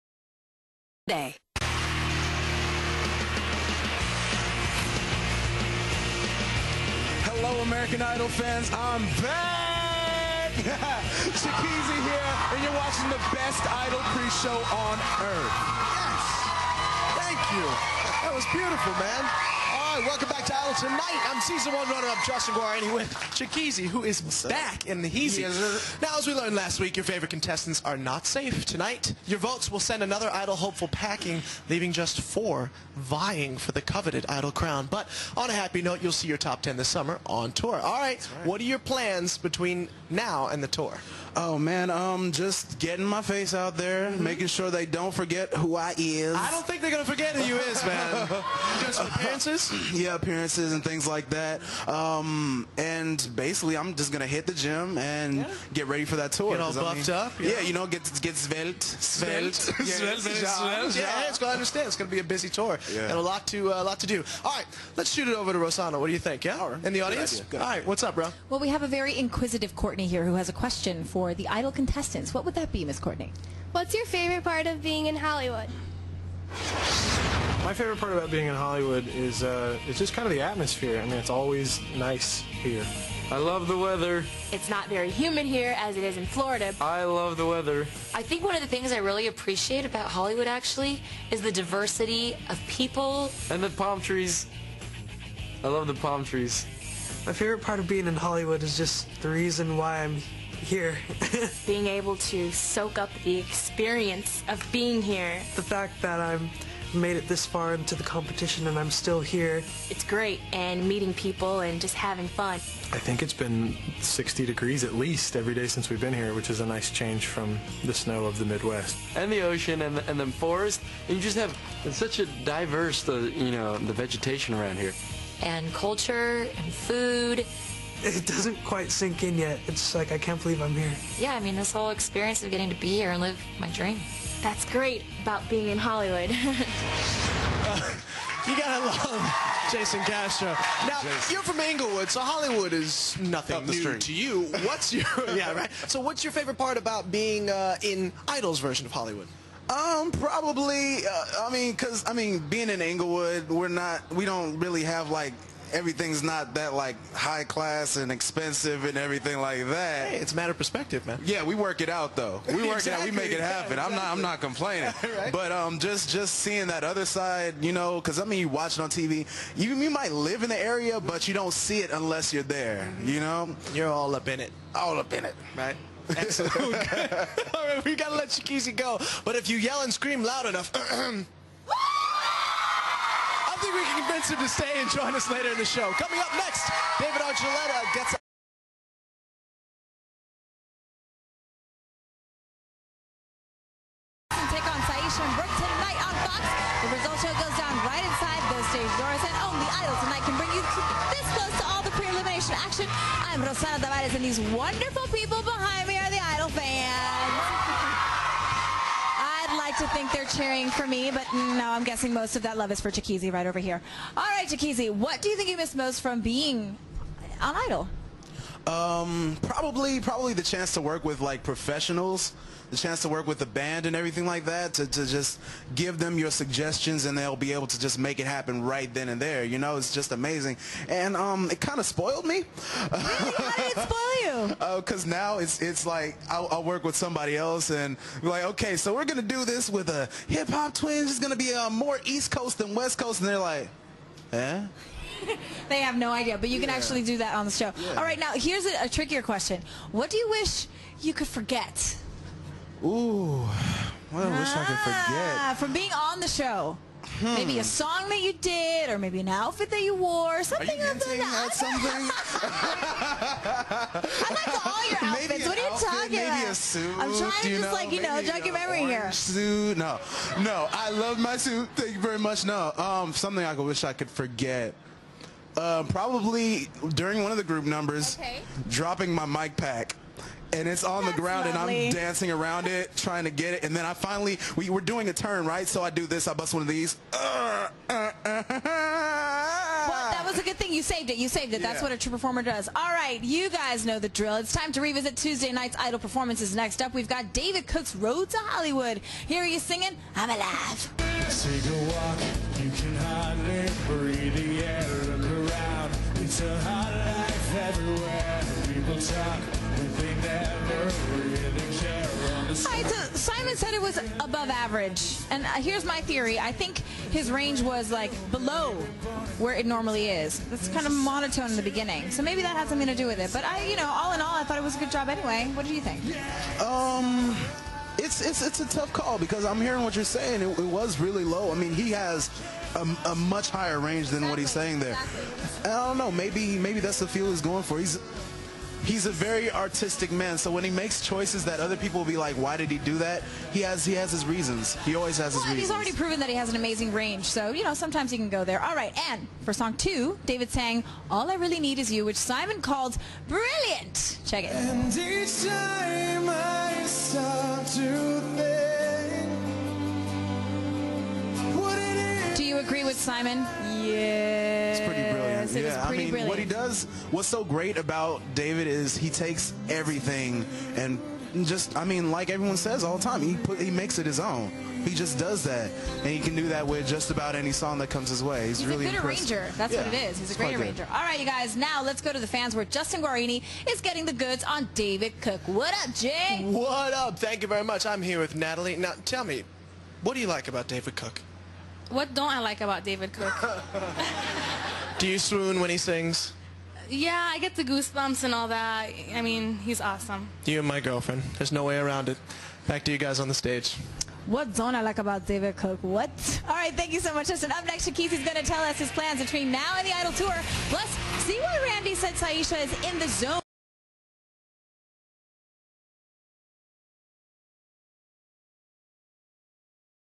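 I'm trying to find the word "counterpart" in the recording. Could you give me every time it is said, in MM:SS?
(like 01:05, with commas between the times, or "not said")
not said.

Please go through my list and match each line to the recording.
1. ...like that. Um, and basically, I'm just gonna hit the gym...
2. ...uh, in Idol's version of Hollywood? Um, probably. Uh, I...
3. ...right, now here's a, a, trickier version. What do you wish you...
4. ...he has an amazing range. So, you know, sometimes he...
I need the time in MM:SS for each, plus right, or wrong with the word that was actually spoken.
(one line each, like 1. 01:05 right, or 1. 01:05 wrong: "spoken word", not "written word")
1. 00:51 right
2. 02:27 right
3. 04:08 wrong: "question", not "version"
4. 05:46 right.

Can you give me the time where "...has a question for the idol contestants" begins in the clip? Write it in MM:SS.
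01:10.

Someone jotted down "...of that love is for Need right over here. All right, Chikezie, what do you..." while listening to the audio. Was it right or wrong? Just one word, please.
wrong.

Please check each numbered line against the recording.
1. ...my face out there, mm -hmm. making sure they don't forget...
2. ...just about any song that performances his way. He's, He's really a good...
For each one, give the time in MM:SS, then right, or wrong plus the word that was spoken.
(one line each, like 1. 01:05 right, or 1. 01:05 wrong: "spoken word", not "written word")
1. 00:43 right
2. 06:16 wrong: "comes", not "performances".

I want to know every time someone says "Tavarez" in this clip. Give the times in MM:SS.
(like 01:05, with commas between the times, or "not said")
03:23.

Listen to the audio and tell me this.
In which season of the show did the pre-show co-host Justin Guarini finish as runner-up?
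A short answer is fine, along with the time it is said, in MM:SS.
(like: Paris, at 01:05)
Season one, at 00:21.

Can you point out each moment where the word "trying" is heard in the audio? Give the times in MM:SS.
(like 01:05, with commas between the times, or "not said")
04:27, 04:42.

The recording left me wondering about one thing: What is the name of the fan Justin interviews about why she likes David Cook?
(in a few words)
Natalie.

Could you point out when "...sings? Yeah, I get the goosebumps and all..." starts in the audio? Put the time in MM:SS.
06:35.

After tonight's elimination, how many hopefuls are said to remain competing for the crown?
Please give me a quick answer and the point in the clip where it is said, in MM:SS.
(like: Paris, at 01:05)
4, at 00:32.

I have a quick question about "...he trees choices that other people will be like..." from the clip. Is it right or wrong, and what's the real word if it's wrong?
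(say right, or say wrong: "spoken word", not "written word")
wrong: "makes", not "trees".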